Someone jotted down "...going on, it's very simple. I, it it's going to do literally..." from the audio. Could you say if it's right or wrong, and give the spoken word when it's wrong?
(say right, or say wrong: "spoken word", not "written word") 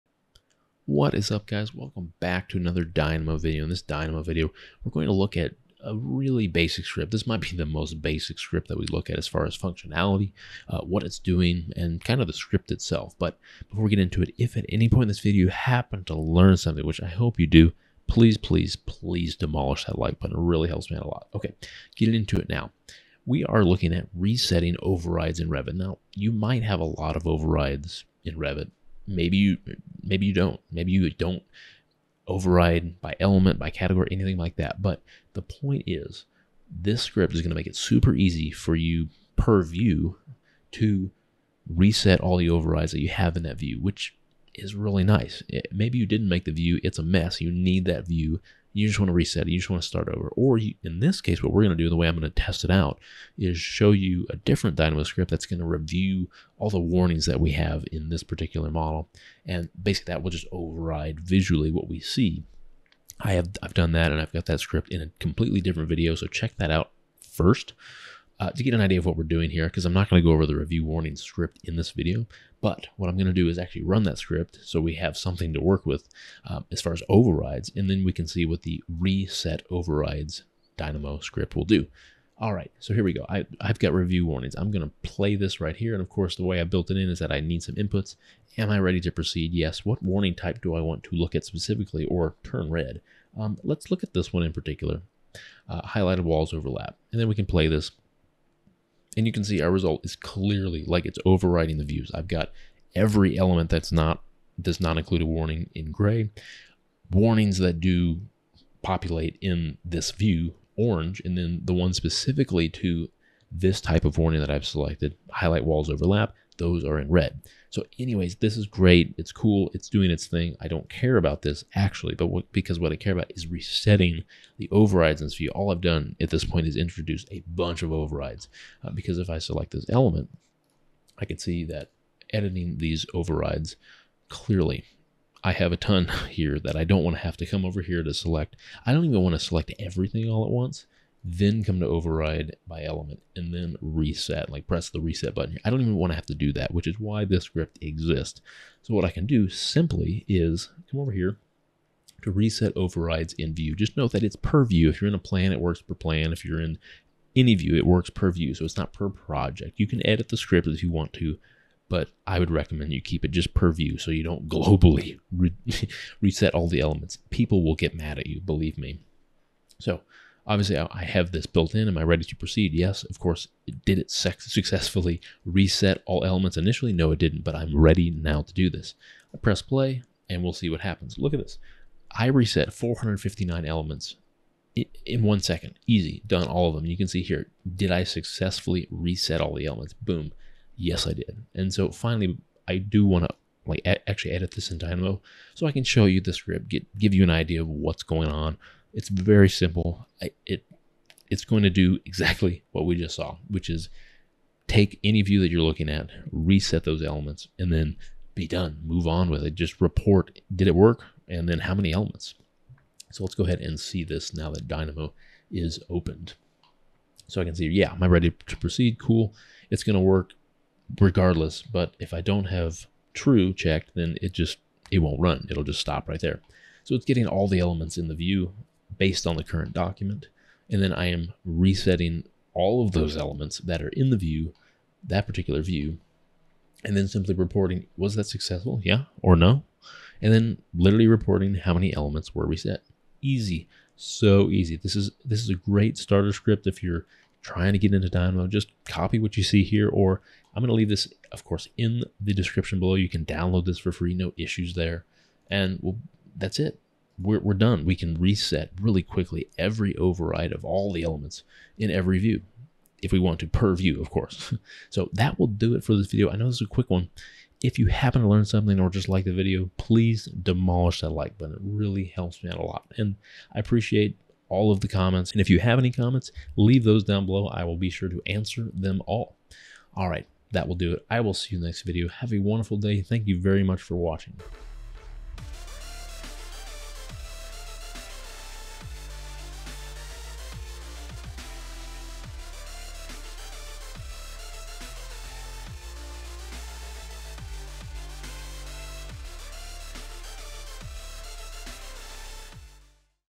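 wrong: "exactly", not "literally".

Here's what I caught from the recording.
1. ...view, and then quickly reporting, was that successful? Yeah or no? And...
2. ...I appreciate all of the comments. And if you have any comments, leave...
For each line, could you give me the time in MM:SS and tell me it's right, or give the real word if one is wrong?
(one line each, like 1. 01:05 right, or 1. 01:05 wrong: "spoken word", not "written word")
1. 03:55 wrong: "simply", not "quickly"
2. 04:33 right.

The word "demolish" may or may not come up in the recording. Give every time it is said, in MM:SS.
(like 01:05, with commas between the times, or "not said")
00:19, 04:30.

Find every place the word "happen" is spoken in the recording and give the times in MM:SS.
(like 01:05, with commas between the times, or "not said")
00:15, 03:00, 04:27.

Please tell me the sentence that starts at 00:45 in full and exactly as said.
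It, eh, maybe you didn't make the view, it's a mess.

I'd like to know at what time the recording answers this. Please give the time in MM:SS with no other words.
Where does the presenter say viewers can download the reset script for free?
04:12.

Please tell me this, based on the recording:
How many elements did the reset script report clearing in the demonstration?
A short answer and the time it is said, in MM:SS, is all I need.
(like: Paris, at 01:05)
459, at 03:02.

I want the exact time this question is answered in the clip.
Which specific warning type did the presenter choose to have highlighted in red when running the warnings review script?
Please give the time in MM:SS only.
01:35.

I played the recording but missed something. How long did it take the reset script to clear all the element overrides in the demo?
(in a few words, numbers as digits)
One second.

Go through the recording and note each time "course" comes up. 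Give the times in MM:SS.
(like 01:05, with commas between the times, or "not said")
01:26, 02:53, 04:11, 04:24.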